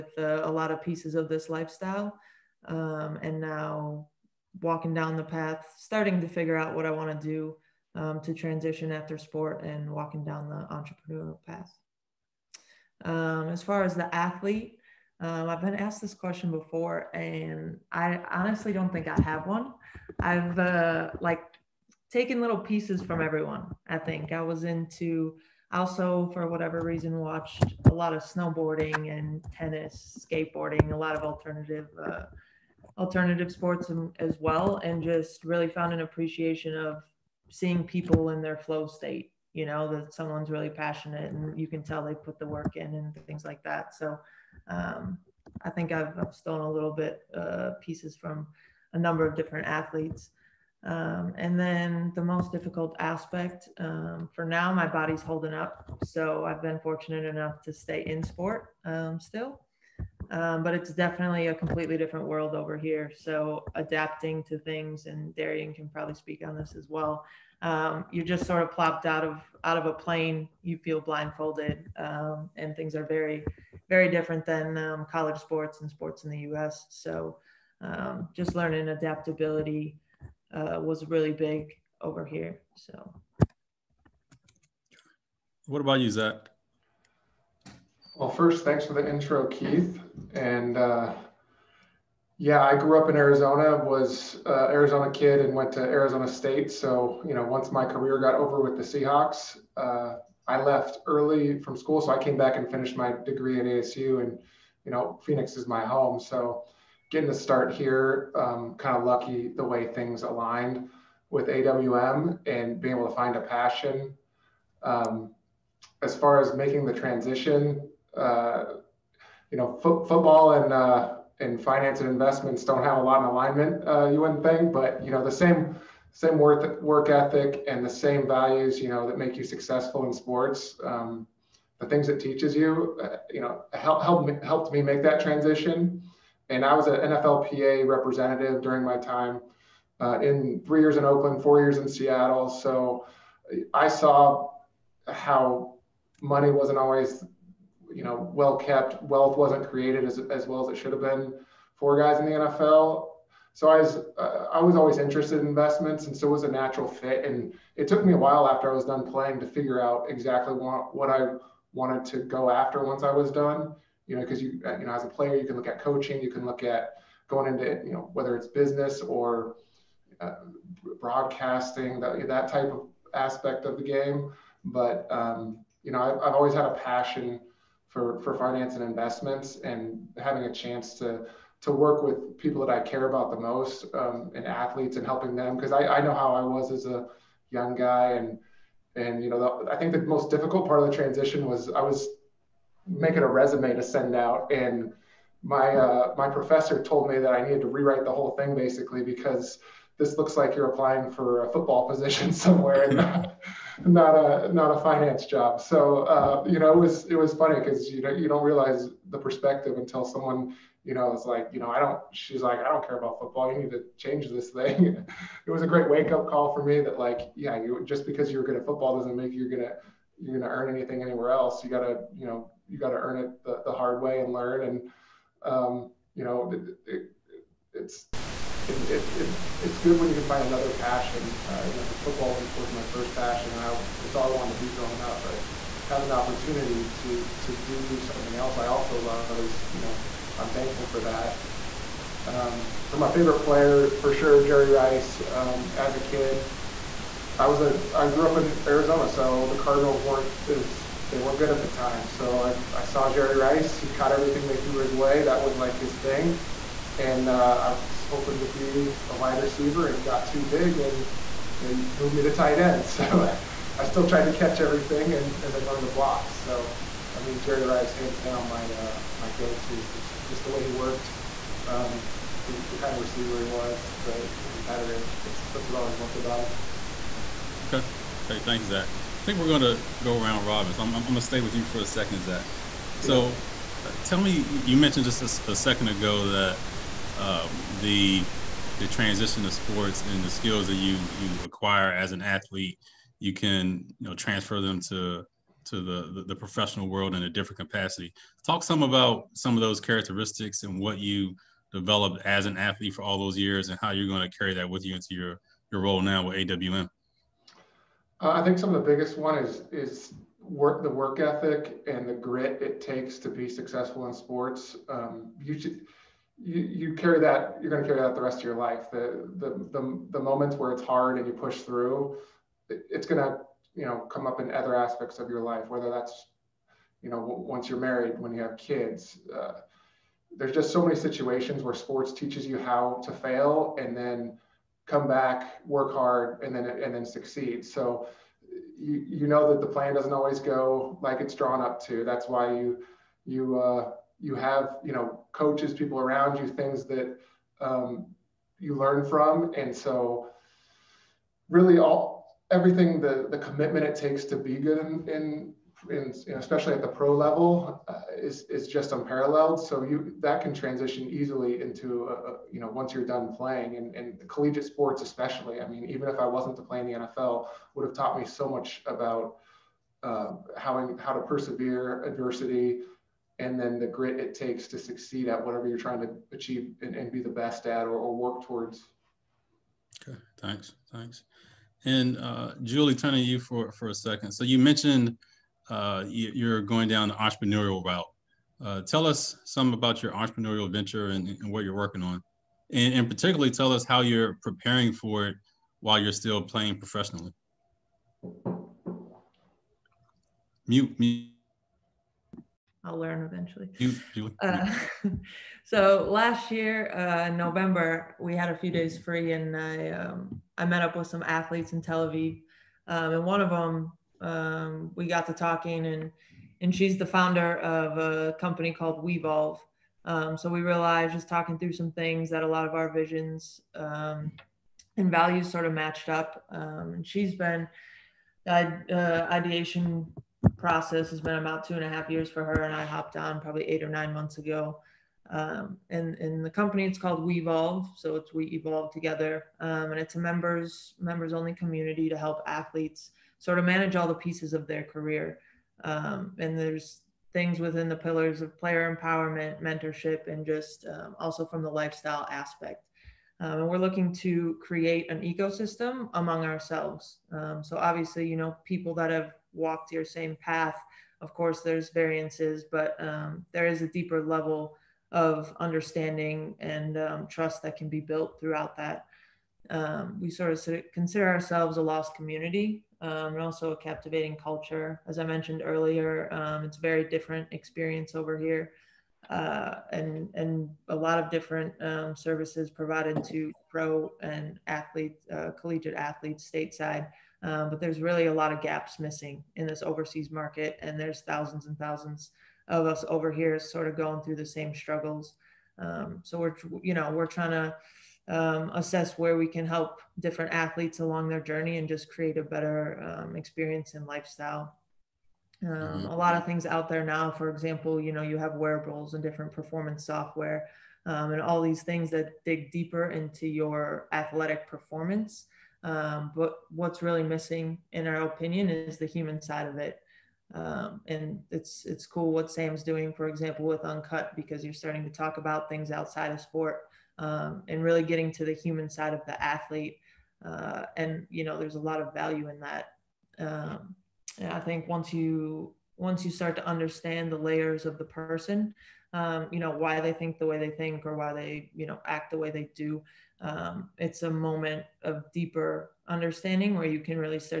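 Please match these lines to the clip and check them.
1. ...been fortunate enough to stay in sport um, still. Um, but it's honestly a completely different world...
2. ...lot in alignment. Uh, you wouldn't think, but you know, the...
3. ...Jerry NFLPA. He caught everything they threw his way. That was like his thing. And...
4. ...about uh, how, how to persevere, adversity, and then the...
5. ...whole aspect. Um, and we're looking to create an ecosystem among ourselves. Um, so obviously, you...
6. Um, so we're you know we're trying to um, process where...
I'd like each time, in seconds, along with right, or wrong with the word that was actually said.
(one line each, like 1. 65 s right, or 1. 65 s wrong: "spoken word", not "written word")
1. 56 s wrong: "definitely", not "honestly"
2. 123 s right
3. 253 s wrong: "Rice", not "NFLPA"
4. 368 s right
5. 451 s wrong: "lifestyle", not "whole"
6. 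495 s wrong: "assess", not "process".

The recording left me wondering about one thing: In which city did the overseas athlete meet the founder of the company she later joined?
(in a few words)
Tel Aviv.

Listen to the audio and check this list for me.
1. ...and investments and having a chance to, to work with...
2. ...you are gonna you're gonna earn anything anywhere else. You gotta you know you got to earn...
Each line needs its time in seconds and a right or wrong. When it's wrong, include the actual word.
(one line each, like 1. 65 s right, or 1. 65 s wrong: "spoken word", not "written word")
1. 178 s right
2. 219 s right.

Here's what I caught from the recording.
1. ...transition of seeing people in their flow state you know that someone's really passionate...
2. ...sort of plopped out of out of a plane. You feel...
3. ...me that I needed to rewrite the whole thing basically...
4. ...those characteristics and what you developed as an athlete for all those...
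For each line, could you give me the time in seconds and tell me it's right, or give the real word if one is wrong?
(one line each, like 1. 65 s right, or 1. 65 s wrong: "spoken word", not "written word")
1. 36 s wrong: "appreciation", not "transition"
2. 68 s right
3. 197 s right
4. 299 s right.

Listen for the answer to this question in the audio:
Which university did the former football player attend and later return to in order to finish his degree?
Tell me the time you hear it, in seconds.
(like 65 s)
95 s.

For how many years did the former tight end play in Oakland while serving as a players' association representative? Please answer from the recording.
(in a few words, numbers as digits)
3.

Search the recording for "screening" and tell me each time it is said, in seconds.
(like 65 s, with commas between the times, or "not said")
not said.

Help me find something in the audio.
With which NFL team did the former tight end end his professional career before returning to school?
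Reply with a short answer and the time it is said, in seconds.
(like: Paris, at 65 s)
Seahawks, at 98 s.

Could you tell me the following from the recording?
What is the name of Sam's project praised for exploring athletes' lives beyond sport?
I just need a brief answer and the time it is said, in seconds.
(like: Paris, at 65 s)
Uncut, at 523 s.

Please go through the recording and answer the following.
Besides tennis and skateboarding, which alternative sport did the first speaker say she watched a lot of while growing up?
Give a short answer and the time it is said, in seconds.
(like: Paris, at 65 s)
Snowboarding, at 28 s.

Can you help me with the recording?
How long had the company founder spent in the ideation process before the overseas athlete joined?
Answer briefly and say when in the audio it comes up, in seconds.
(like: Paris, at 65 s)
2 and a half years, at 431 s.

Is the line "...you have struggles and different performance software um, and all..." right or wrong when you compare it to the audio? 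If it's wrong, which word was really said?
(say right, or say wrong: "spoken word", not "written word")
wrong: "wearables", not "struggles".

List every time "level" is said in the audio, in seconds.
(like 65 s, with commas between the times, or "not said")
357 s, 464 s.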